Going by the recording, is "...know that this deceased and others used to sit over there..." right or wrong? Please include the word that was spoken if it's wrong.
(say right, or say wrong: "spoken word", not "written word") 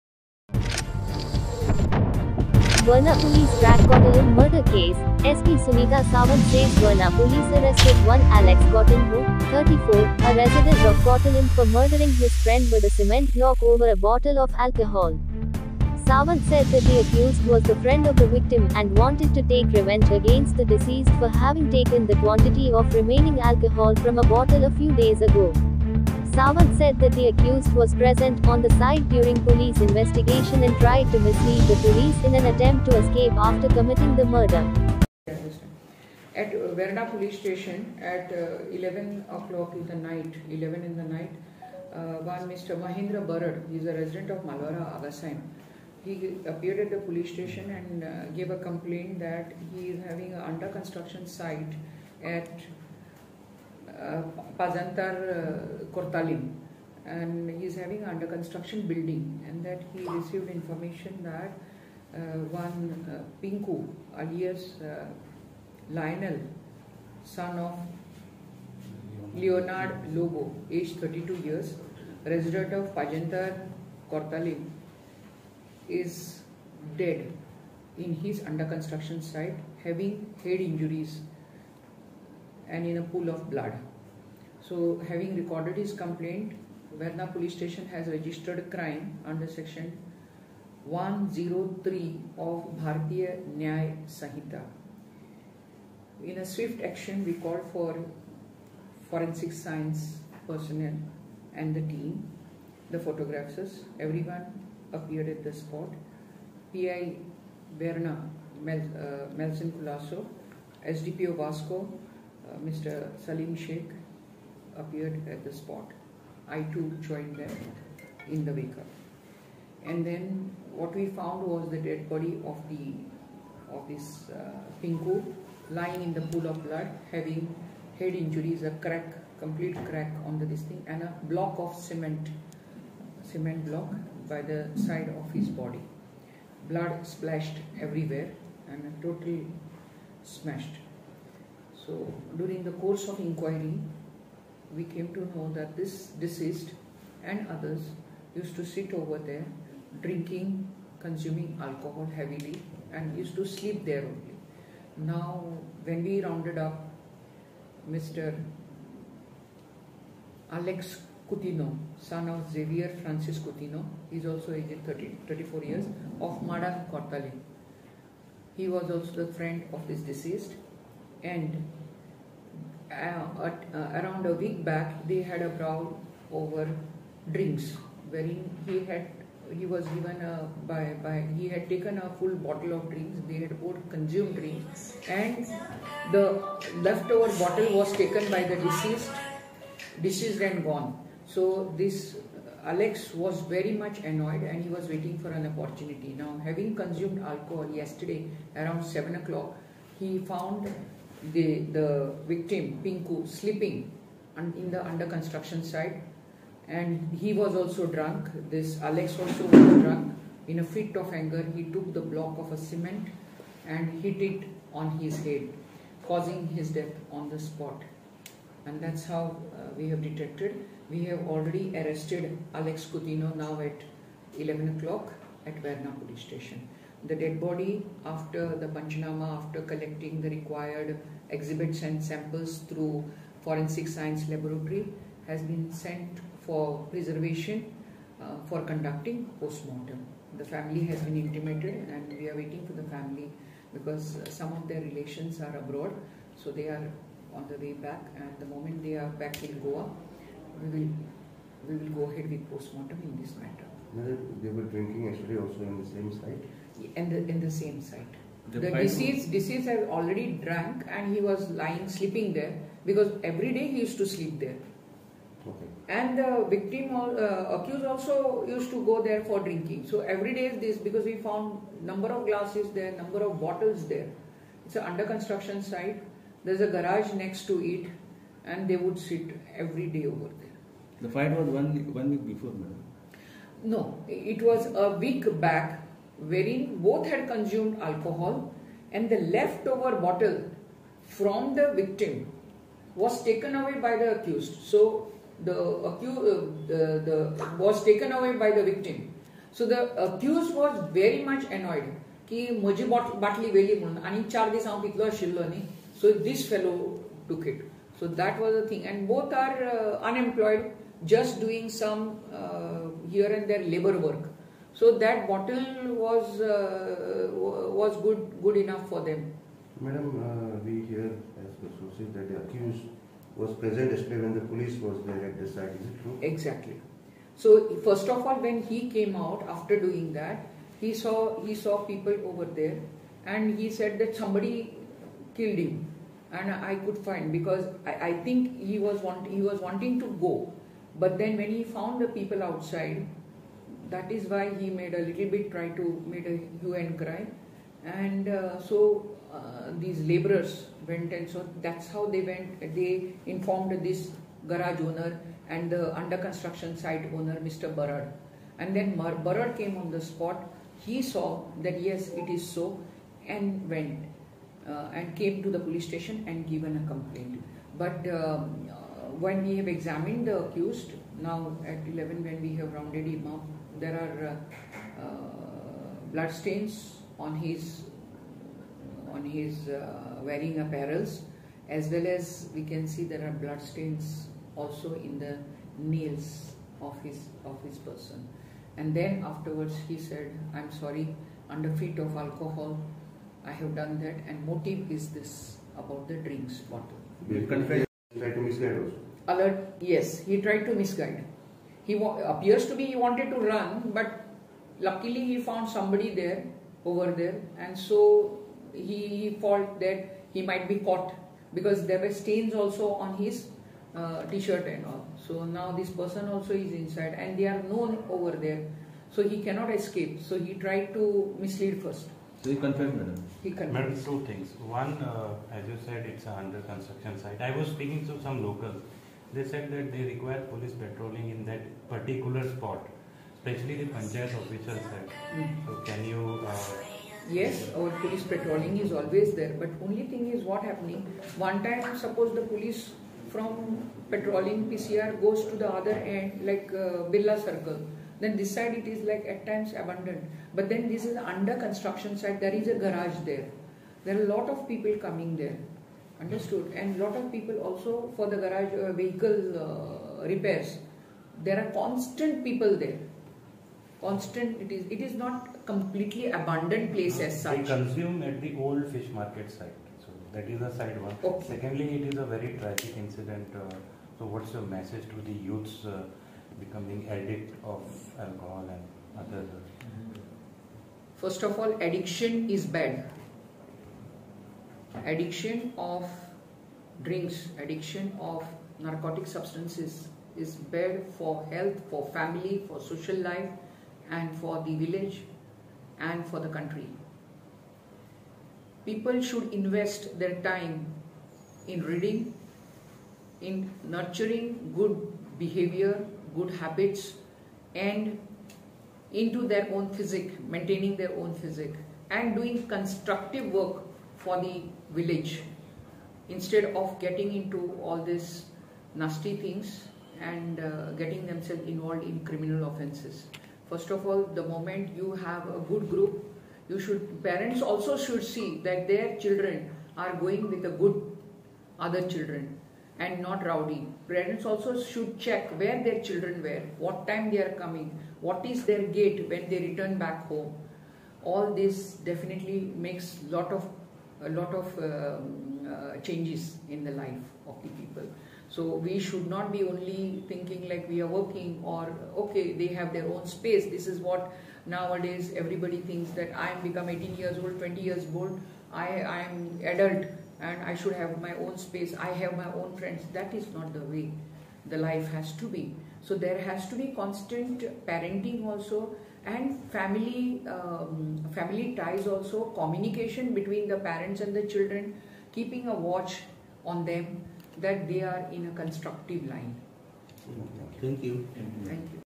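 right.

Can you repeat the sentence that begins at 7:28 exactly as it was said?
Then this side it is like at times abandoned, but then this is under construction side.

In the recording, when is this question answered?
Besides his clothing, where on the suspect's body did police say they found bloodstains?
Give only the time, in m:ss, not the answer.
6:24.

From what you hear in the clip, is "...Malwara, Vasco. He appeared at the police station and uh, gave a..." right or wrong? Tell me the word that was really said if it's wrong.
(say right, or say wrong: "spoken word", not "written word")
wrong: "Agassaim", not "Vasco".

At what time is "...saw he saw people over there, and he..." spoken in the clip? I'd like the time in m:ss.
5:30.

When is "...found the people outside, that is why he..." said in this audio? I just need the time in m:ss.
5:41.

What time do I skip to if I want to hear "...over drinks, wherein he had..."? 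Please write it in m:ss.
2:56.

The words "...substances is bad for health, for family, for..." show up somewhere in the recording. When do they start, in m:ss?
8:09.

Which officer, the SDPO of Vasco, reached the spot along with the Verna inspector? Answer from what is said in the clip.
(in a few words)
Salim Sheikh.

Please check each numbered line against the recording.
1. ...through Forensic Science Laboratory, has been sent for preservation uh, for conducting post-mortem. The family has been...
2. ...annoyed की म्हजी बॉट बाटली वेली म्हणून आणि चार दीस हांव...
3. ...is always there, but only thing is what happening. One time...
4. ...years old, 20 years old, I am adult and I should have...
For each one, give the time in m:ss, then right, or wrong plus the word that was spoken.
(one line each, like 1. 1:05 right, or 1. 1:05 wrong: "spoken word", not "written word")
1. 3:52 right
2. 5:01 right
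3. 7:18 right
4. 9:17 right.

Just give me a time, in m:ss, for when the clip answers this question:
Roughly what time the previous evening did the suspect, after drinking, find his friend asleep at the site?
3:18.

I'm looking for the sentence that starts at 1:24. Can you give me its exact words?
So having recorded his complaint, Verna police station has registered crime under section 103 of Bharatiya Nyay Sanhita.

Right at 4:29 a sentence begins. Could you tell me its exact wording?
So every day is this because we found number of glasses there, number of bottles there.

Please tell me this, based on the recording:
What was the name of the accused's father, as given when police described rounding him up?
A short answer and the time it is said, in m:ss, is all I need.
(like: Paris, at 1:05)
Xavier Francis Coutinho, at 2:42.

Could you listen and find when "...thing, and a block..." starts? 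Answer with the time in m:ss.
2:10.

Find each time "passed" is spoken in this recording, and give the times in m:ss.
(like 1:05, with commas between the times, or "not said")
not said.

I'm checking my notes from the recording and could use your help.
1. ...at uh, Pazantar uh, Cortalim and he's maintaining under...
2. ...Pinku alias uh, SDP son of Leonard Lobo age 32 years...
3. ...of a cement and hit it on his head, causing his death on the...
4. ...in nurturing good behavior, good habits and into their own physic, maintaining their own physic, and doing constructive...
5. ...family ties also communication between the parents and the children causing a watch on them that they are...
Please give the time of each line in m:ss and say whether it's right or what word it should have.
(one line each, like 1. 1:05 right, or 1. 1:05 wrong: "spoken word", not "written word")
1. 0:52 wrong: "having", not "maintaining"
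2. 1:03 wrong: "Lionel", not "SDP"
3. 3:32 right
4. 8:23 right
5. 9:31 wrong: "keeping", not "causing".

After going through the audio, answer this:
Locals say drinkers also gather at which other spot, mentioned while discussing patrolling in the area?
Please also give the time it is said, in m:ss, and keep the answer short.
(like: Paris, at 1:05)
old fish market, at 7:48.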